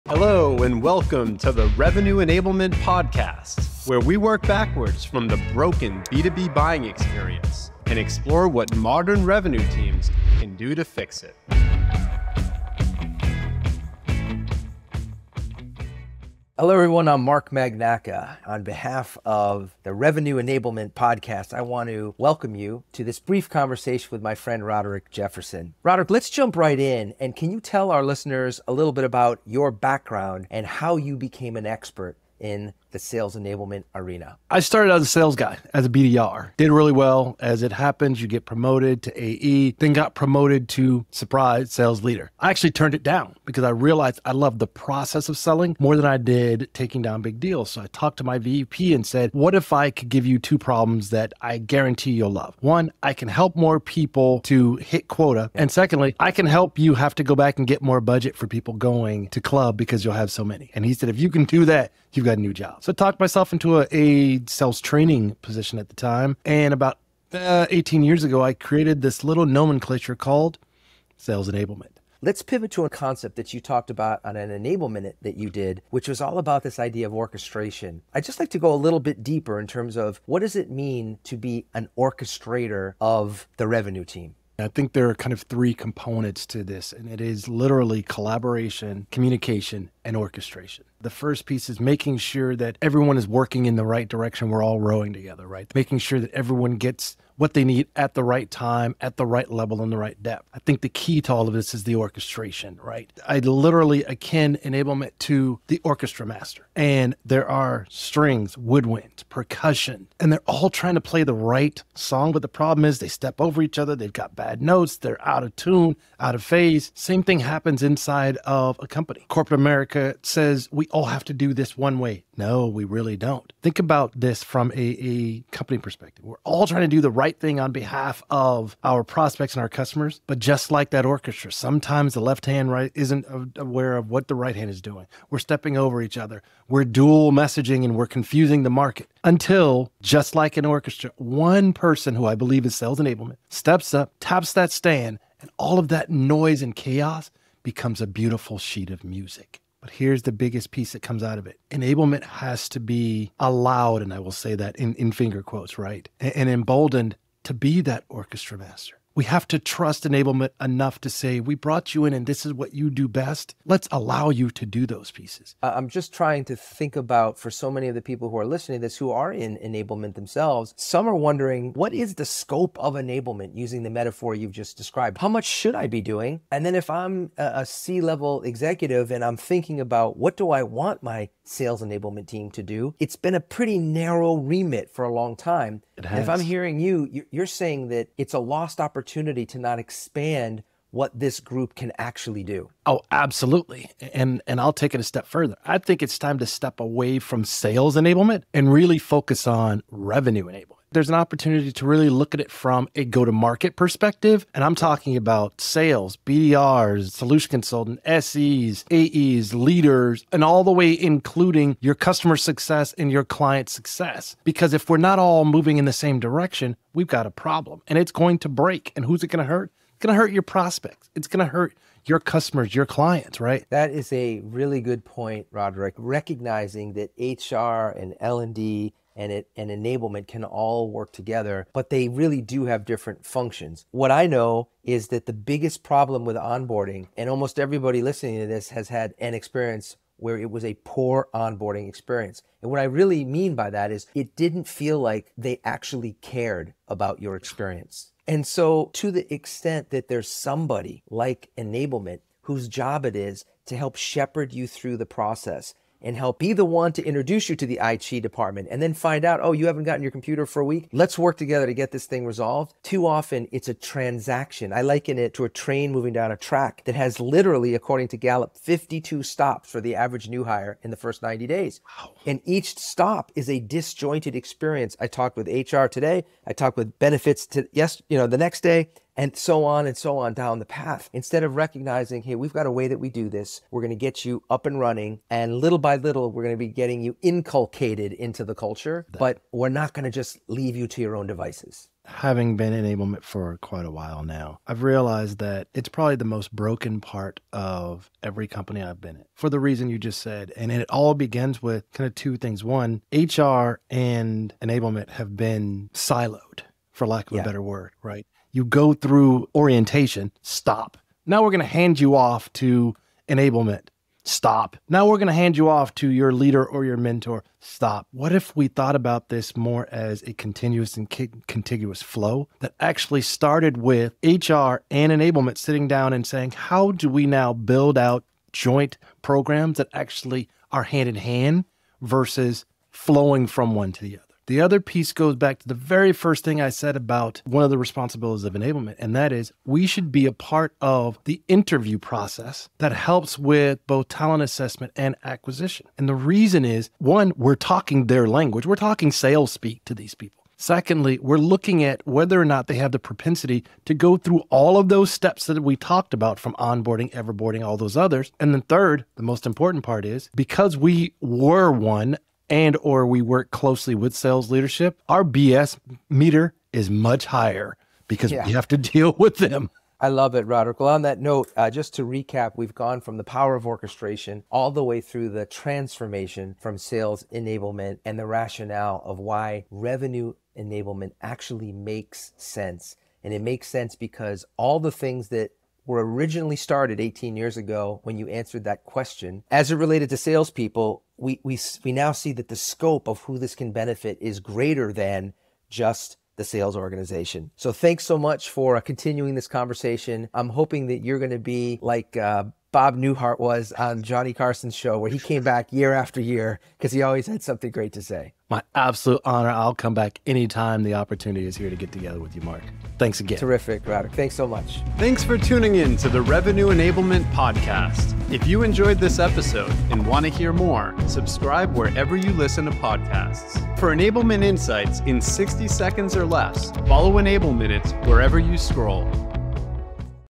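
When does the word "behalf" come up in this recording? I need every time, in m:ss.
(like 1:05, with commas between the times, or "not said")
0:18, 2:07.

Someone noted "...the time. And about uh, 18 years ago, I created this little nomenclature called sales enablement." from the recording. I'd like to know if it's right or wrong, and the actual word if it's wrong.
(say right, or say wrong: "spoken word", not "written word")
right.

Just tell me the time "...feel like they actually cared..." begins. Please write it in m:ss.
4:04.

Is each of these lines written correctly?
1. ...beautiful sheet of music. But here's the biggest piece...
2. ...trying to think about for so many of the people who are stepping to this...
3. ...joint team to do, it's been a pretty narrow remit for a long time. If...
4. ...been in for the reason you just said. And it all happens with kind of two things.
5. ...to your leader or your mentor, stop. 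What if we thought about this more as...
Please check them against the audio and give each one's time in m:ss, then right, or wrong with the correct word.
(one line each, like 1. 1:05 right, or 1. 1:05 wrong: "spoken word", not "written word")
1. 2:28 right
2. 2:46 wrong: "listening", not "stepping"
3. 3:01 wrong: "enablement", not "joint"
4. 4:58 wrong: "begins", not "happens"
5. 5:15 right.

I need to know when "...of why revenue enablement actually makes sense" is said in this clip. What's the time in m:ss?
6:19.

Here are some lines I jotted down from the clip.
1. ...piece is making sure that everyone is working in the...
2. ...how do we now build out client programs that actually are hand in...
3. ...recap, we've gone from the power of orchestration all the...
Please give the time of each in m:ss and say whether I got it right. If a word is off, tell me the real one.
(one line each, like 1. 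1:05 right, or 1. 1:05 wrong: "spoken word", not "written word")
1. 1:31 right
2. 5:26 wrong: "joint", not "client"
3. 6:12 right.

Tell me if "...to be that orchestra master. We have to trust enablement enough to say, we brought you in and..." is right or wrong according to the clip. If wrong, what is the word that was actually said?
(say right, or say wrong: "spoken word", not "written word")
right.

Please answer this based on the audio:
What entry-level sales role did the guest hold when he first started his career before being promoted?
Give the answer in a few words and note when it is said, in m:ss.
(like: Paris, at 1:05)
BDR, at 0:35.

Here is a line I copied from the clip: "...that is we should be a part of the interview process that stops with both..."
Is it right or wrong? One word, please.
wrong.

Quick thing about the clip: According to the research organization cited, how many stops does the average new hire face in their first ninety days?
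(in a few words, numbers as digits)
52.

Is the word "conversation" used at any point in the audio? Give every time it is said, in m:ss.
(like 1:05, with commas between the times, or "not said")
0:23, 6:39.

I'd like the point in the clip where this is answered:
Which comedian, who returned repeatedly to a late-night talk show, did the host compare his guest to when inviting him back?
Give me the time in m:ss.
6:42.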